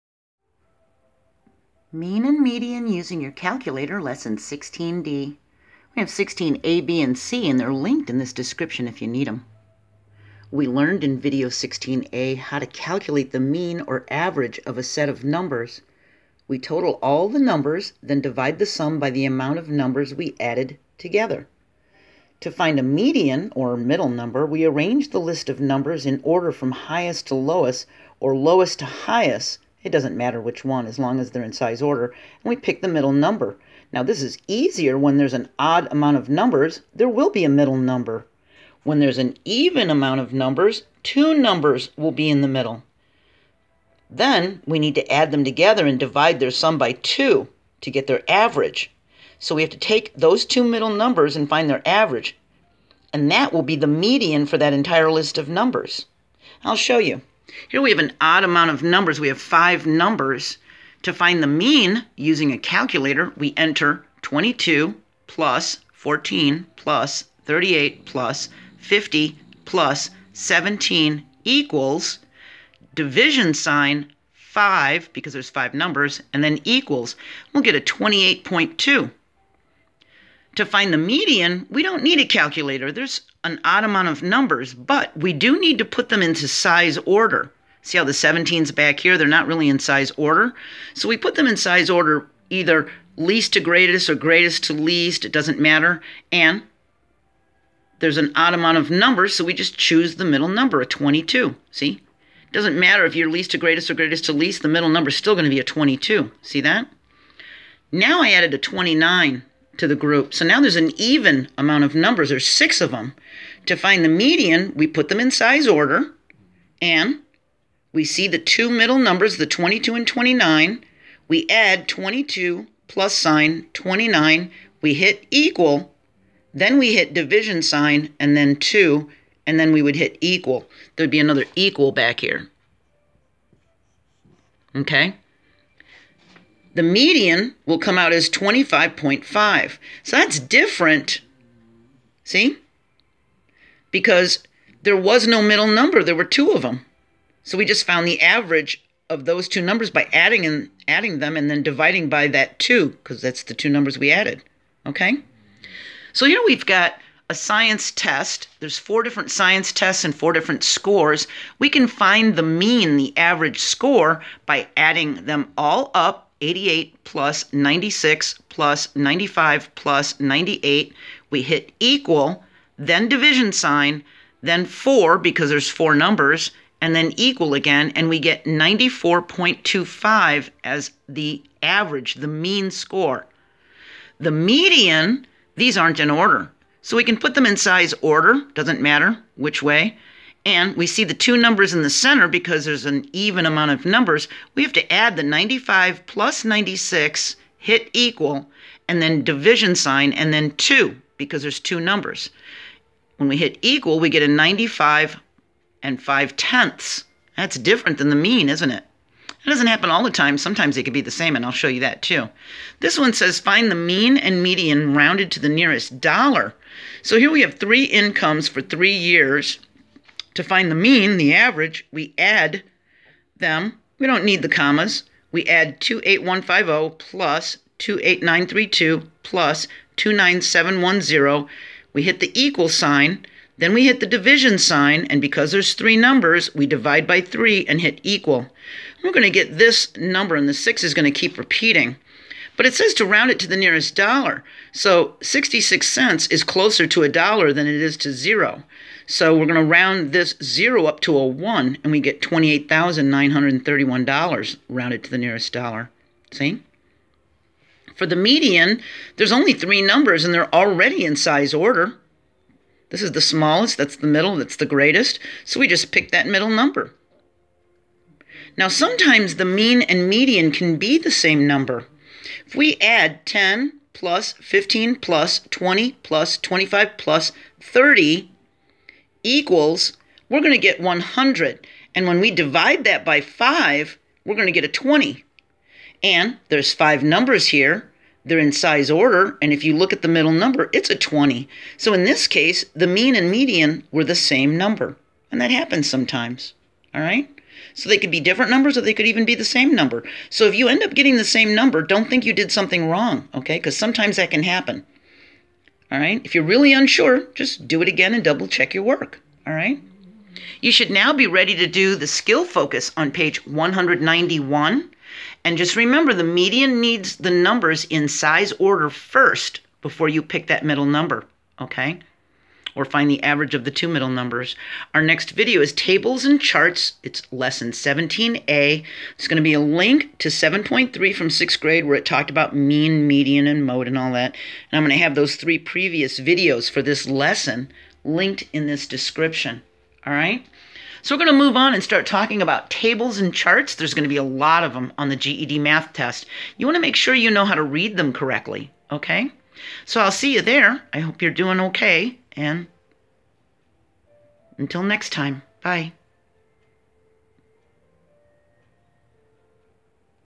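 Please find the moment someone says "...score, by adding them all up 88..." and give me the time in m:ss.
2:43.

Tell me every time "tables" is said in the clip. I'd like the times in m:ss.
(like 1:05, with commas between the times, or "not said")
5:25, 5:42.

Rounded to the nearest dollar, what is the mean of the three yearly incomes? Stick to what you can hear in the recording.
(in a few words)
$28,931.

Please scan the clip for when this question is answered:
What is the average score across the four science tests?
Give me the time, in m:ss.
2:58.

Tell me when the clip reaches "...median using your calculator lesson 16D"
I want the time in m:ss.
0:02.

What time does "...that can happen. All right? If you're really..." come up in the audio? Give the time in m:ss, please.
5:04.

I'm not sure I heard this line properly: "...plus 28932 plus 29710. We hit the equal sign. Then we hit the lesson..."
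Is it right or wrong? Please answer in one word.
wrong.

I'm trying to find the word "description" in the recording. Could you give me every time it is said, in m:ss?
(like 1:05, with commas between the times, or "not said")
0:08, 5:38.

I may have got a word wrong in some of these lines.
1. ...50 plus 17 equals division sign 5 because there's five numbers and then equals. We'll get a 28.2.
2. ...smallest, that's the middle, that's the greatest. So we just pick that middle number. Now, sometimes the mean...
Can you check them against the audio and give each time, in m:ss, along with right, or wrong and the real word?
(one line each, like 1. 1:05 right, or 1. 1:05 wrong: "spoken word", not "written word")
1. 1:08 right
2. 4:23 right.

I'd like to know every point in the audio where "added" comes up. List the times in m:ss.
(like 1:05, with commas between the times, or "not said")
0:20, 1:48, 2:34.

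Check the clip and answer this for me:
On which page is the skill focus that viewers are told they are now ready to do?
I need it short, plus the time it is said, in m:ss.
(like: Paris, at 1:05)
191, at 5:13.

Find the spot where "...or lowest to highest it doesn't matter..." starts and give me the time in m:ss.
0:28.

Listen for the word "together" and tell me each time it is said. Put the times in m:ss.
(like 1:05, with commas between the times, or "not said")
0:20, 0:45.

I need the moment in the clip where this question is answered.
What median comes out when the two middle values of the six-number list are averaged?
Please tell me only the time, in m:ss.
2:18.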